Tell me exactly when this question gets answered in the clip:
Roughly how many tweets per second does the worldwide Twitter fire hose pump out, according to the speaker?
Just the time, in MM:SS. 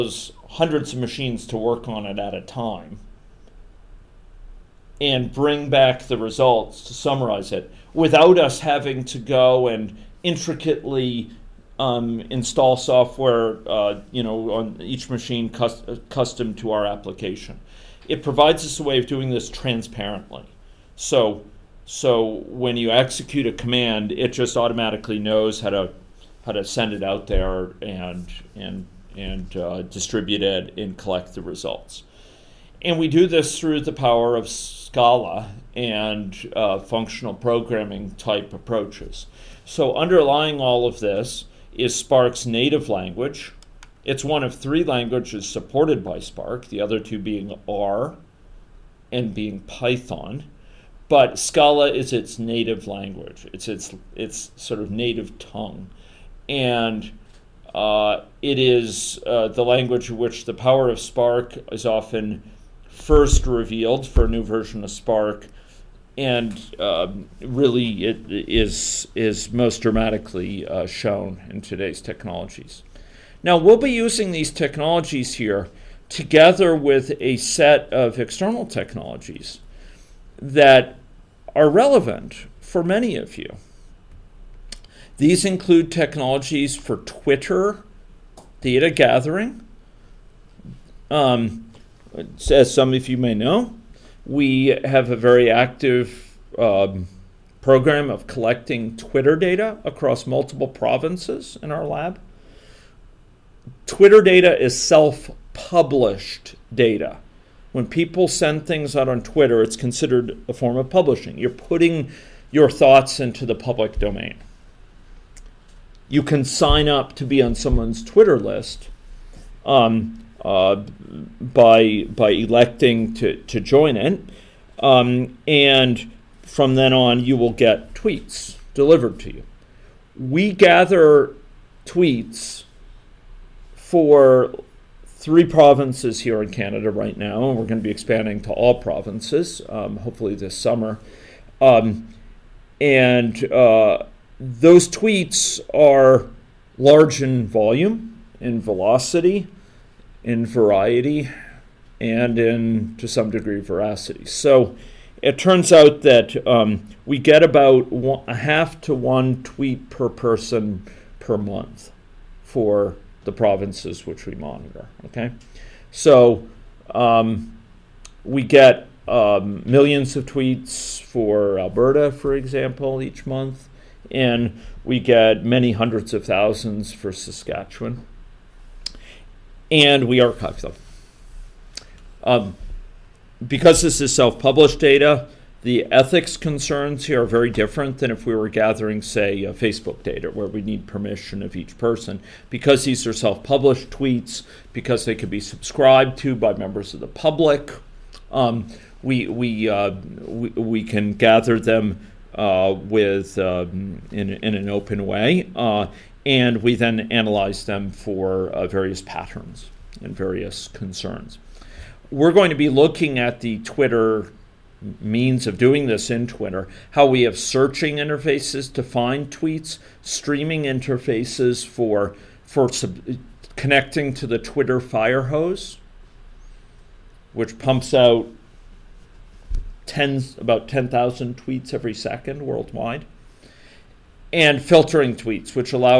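03:50.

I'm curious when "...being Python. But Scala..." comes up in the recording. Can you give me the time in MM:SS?
00:49.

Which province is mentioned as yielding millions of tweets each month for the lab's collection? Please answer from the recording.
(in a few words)
Alberta.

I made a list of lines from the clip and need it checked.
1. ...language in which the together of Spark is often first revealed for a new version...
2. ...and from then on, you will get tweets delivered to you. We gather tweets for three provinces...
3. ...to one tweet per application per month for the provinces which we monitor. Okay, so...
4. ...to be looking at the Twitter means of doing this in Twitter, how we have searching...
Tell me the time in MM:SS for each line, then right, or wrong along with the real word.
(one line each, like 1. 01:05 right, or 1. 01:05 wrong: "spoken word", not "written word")
1. 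00:59 wrong: "power", not "together"
2. 02:05 right
3. 02:38 wrong: "person", not "application"
4. 03:32 right.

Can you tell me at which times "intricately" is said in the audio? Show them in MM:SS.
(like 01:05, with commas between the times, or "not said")
00:10.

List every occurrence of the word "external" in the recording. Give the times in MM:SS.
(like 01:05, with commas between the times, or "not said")
01:18.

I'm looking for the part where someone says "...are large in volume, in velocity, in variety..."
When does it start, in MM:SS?
02:25.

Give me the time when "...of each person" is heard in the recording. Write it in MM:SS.
03:11.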